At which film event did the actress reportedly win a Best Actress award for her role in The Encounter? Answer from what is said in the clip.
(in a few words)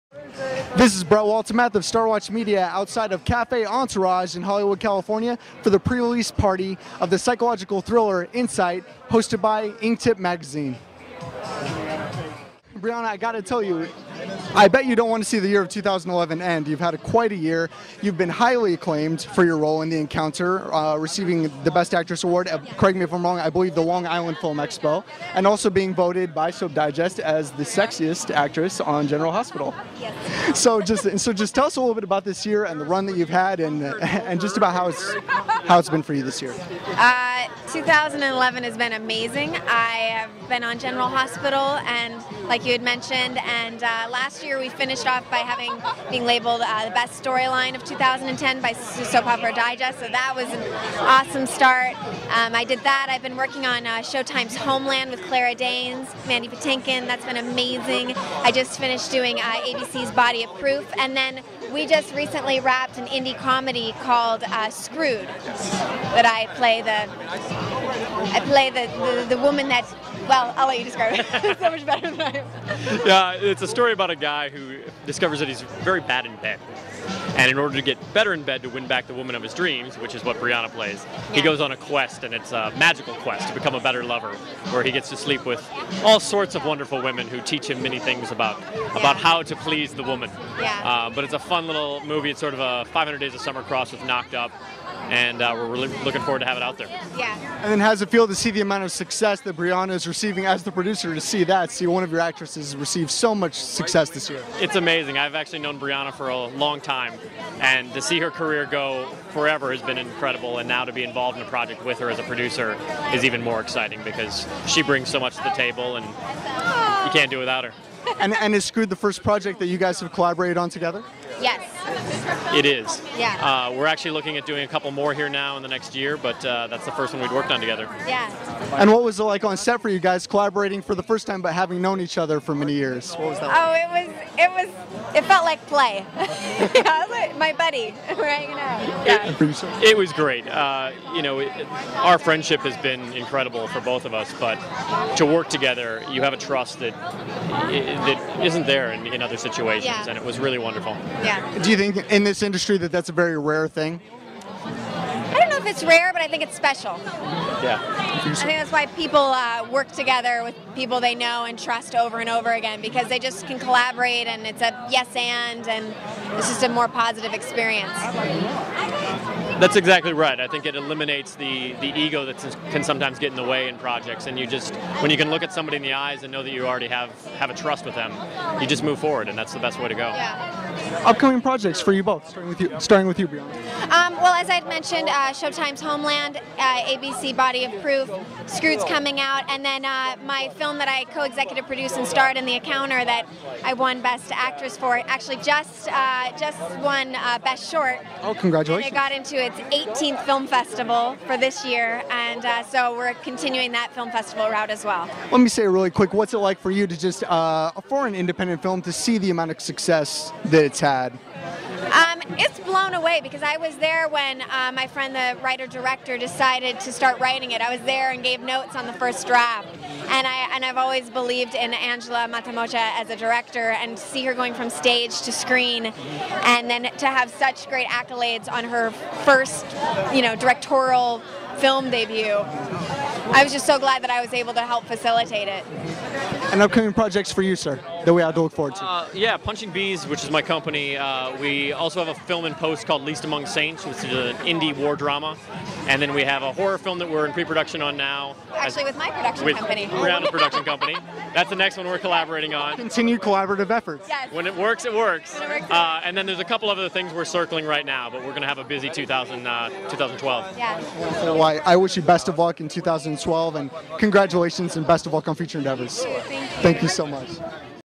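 Long Island Film Expo.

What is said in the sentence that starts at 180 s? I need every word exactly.
Yeah upcoming projects for you both, starting with you, starting with you, Brianna.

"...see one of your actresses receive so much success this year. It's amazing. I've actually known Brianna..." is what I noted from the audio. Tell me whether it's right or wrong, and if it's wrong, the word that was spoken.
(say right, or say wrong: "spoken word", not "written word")
right.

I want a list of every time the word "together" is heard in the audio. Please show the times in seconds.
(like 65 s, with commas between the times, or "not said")
120 s, 127 s, 145 s, 159 s.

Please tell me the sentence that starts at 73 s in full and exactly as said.
yeah, it's a story about a guy who discovers that he's very bad in bed.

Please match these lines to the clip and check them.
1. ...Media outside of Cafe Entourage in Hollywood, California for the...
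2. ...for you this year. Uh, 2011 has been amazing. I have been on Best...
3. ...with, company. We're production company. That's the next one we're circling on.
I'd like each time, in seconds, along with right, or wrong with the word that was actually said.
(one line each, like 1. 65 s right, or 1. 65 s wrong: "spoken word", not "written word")
1. 2 s right
2. 36 s wrong: "General", not "Best"
3. 249 s wrong: "collaborating", not "circling".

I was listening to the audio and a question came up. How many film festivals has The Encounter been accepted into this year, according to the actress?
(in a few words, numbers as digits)
18.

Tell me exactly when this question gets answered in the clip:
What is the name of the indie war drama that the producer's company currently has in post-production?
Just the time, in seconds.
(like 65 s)
243 s.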